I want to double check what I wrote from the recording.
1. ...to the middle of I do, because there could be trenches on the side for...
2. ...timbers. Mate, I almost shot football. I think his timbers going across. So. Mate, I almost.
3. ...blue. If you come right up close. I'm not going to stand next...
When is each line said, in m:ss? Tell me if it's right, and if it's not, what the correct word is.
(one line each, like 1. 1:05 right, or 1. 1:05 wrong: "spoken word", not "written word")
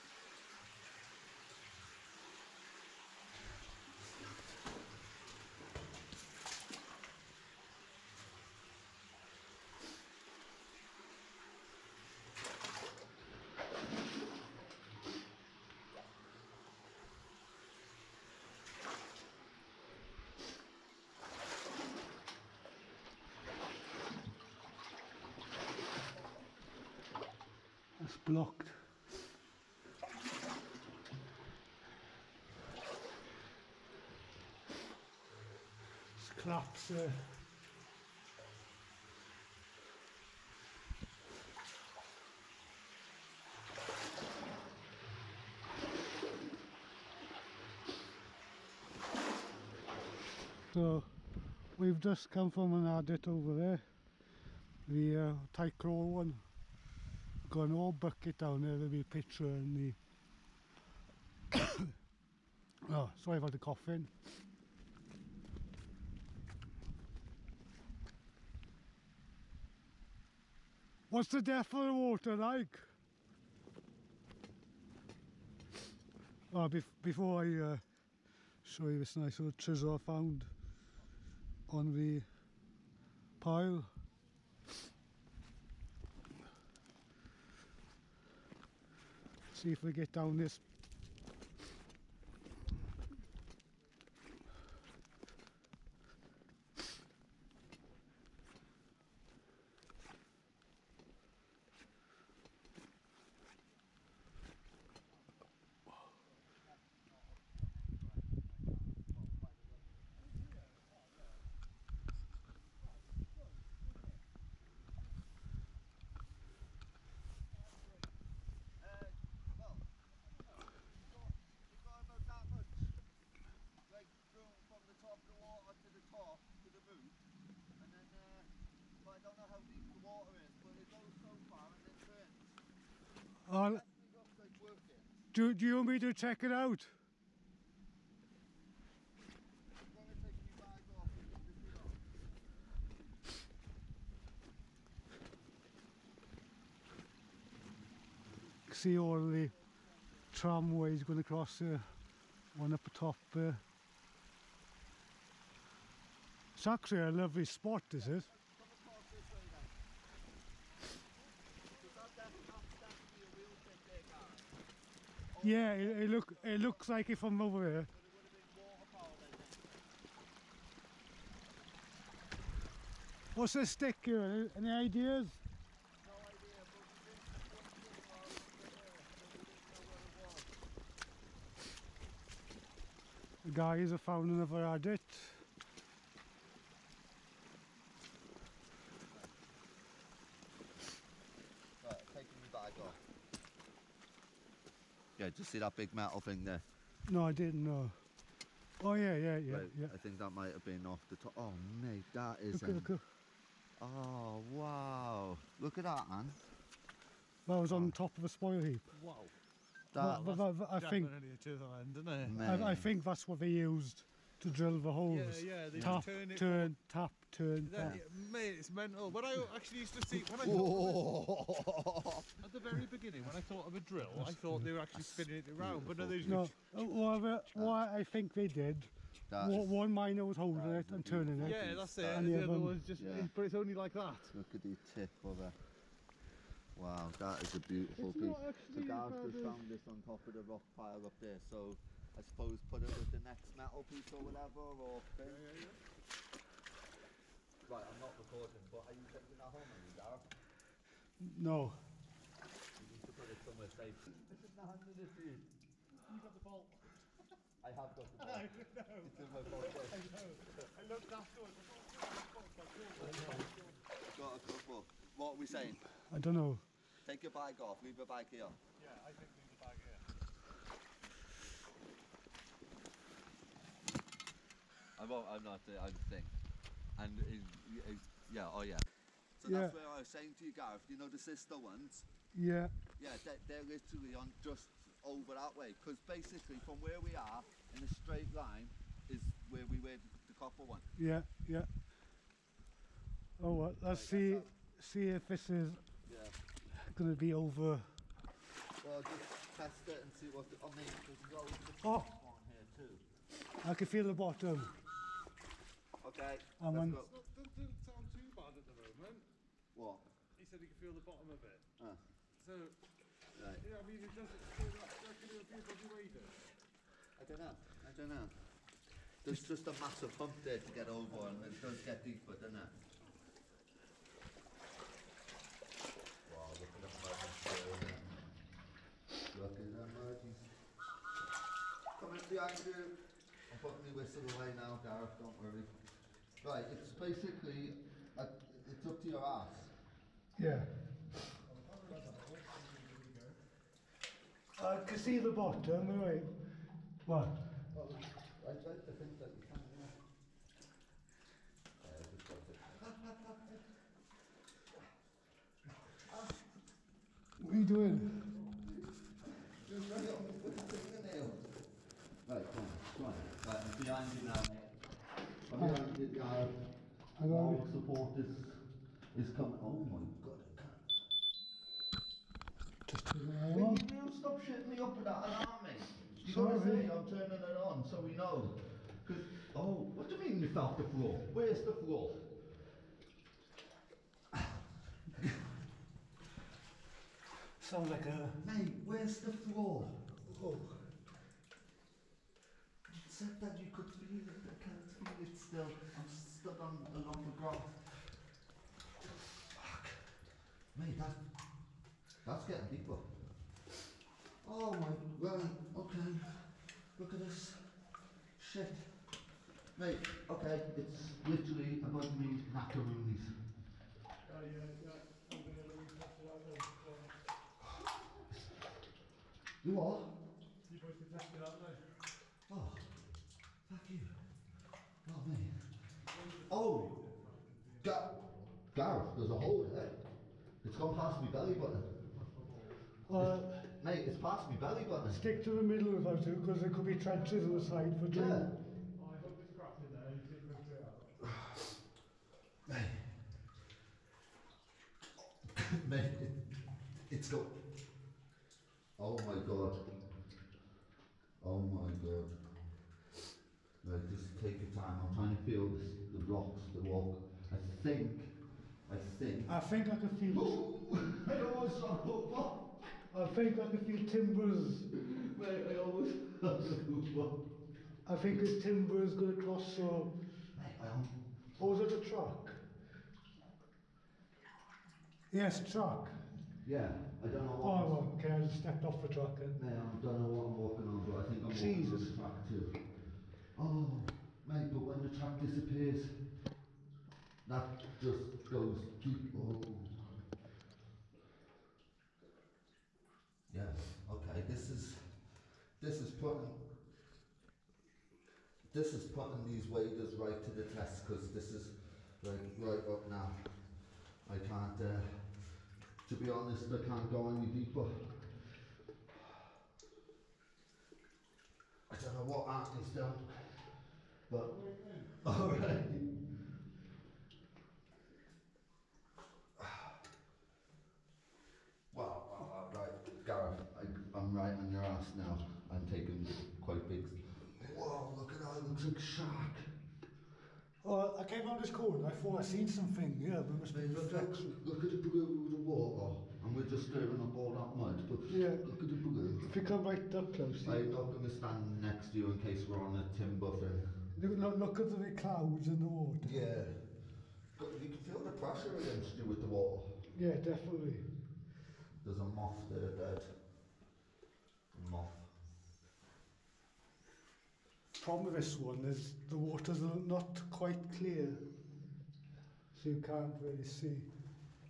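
1. 7:15 right
2. 7:44 right
3. 8:58 right.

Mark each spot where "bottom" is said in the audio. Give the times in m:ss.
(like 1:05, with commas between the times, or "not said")
5:04, 5:11, 5:45.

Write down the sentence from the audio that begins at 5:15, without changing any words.
you reckon a I don't know.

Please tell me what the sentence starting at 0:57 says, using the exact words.
Going all old bucket down there with a picture in the...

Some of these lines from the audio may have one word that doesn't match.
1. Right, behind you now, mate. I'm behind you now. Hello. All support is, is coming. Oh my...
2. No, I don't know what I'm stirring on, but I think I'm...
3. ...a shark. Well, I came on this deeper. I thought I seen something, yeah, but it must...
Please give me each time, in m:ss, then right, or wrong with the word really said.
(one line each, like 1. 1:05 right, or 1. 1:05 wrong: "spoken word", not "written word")
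1. 6:03 right
2. 7:59 wrong: "walking", not "stirring"
3. 8:48 wrong: "corner", not "deeper".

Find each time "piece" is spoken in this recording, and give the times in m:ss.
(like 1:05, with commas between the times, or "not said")
3:58, 4:03.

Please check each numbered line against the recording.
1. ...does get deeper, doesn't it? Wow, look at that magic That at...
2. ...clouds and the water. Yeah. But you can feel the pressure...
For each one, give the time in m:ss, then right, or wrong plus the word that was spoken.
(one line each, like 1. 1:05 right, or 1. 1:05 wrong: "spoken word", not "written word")
1. 5:21 wrong: "Look", not "That"
2. 9:05 right.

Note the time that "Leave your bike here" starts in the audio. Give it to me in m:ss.
4:27.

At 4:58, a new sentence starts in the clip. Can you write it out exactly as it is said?
Well, just test it and see what.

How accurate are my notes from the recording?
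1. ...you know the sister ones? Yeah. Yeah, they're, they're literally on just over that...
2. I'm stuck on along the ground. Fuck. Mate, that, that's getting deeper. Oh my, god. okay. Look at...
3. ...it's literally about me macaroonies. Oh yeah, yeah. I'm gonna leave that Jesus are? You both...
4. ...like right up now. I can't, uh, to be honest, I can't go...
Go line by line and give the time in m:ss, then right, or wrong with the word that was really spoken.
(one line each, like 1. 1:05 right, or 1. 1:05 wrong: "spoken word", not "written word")
1. 4:40 right
2. 6:35 right
3. 6:50 wrong: "You", not "Jesus"
4. 8:22 right.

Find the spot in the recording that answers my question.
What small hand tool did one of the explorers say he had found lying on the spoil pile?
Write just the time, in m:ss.
1:19.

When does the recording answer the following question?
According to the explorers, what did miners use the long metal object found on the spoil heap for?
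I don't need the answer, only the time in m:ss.
3:34.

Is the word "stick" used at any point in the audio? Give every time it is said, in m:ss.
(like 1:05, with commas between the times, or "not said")
2:53, 7:15.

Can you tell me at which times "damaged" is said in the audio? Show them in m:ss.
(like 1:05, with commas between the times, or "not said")
not said.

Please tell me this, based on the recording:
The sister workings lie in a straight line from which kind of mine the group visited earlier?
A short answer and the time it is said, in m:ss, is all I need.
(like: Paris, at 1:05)
copper, at 4:50.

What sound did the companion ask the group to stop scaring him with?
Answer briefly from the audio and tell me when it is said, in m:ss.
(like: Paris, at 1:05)
alarm, at 6:15.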